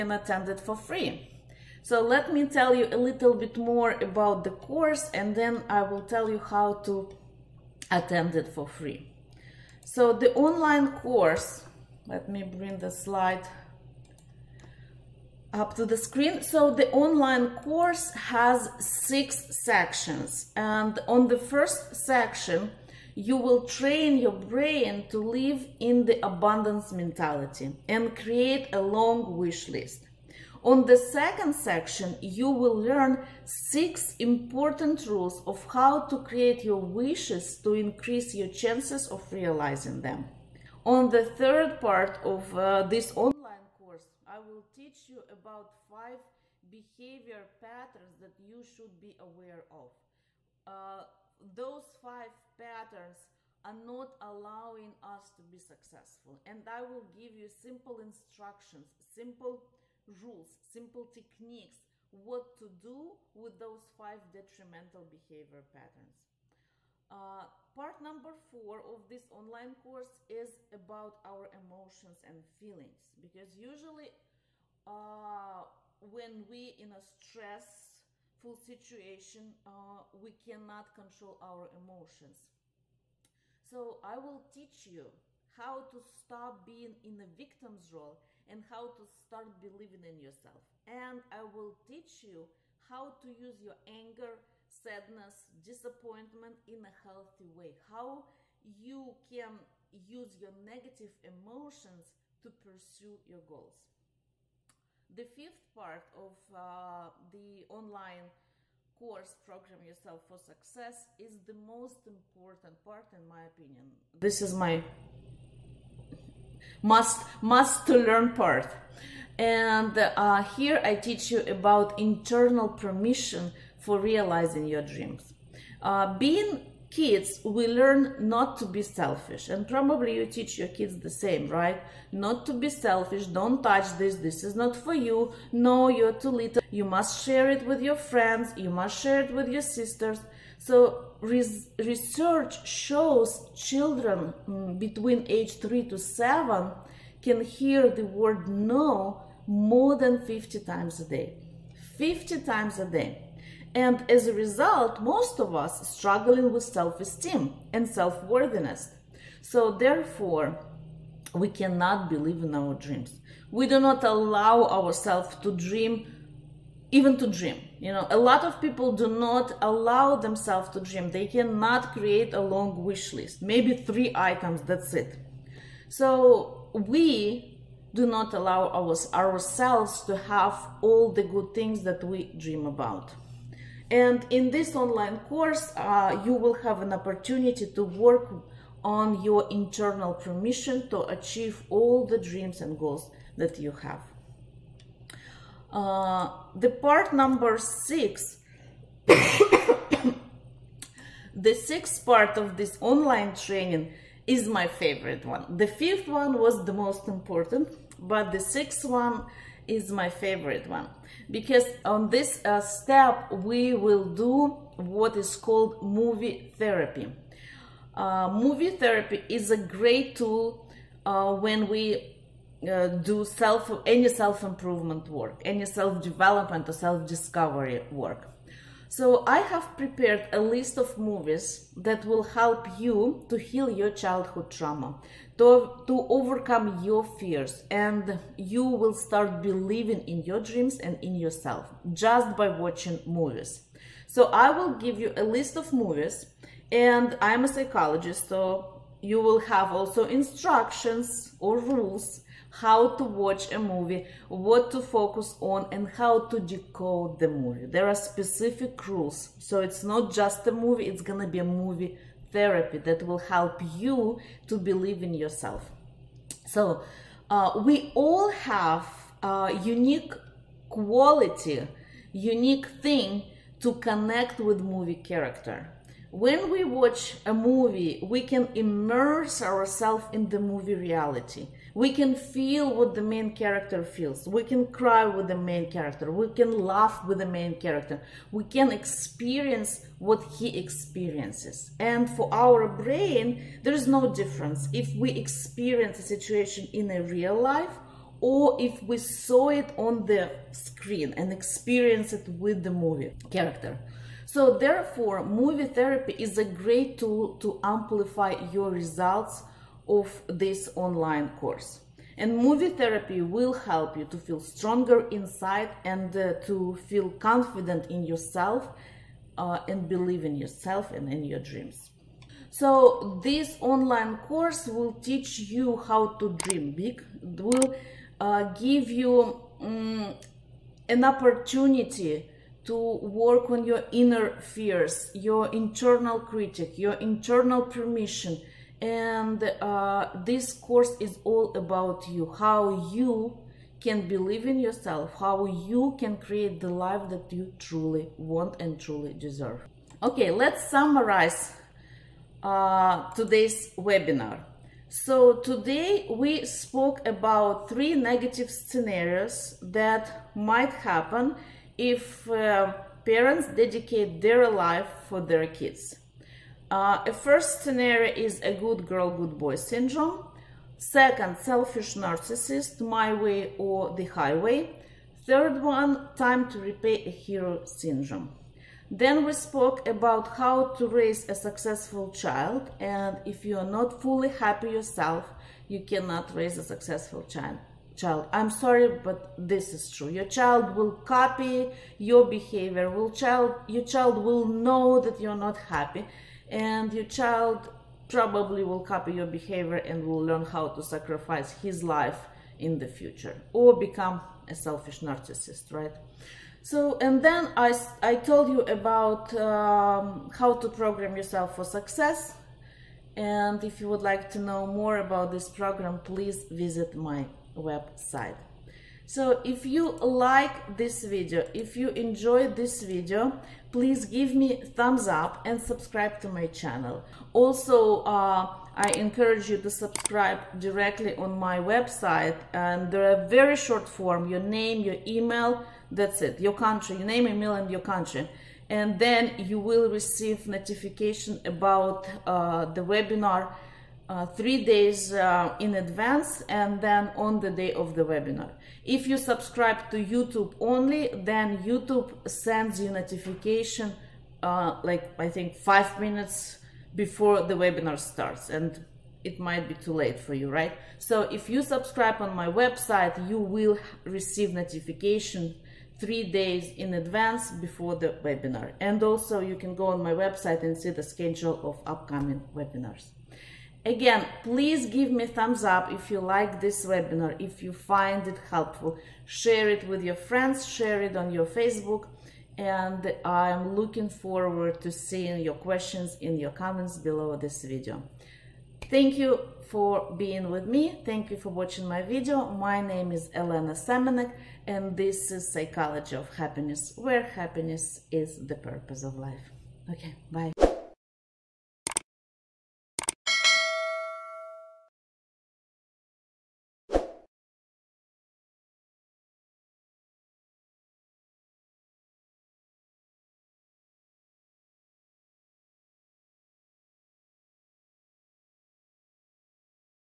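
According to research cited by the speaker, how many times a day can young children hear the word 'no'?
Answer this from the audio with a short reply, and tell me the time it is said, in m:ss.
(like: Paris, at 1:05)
more than 50, at 2:29.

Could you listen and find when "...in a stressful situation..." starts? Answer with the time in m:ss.
1:16.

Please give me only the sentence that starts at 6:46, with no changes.
So, and then I, I told you about um, how to program yourself for success.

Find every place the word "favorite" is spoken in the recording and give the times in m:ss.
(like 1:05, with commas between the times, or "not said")
3:24, 3:30.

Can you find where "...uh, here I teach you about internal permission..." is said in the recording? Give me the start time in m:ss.
1:59.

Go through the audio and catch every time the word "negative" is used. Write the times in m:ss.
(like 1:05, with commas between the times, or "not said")
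1:40, 5:57.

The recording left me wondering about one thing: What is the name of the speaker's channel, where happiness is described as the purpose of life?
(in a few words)
Psychology of Happiness.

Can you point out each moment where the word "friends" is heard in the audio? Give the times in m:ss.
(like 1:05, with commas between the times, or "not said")
2:17, 8:00.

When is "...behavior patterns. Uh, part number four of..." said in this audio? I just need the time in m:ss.
1:05.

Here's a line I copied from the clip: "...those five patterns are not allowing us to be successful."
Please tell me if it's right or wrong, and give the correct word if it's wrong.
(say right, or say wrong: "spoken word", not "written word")
right.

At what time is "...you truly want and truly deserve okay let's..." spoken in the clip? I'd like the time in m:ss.
5:47.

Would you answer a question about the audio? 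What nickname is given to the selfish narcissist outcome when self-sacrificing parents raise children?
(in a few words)
my way or the highway.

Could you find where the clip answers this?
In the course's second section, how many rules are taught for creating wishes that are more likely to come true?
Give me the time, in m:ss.
0:33.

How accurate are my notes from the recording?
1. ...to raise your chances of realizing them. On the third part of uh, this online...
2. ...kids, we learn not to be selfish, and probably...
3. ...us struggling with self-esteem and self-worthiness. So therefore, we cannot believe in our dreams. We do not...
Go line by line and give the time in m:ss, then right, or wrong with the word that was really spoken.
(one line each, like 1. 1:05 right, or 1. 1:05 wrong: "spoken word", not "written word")
1. 0:37 wrong: "increase", not "raise"
2. 2:06 right
3. 2:35 right.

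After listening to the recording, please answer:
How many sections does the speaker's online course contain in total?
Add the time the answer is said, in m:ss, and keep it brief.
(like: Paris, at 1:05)
6, at 0:18.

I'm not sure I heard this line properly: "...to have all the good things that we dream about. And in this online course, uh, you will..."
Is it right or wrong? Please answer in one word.
right.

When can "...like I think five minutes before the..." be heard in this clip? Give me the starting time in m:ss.
7:34.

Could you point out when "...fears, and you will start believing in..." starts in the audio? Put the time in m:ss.
3:57.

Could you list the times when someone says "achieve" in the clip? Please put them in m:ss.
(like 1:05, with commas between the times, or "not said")
3:11.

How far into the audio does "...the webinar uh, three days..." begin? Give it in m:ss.
7:22.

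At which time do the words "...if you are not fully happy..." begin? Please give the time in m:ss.
6:23.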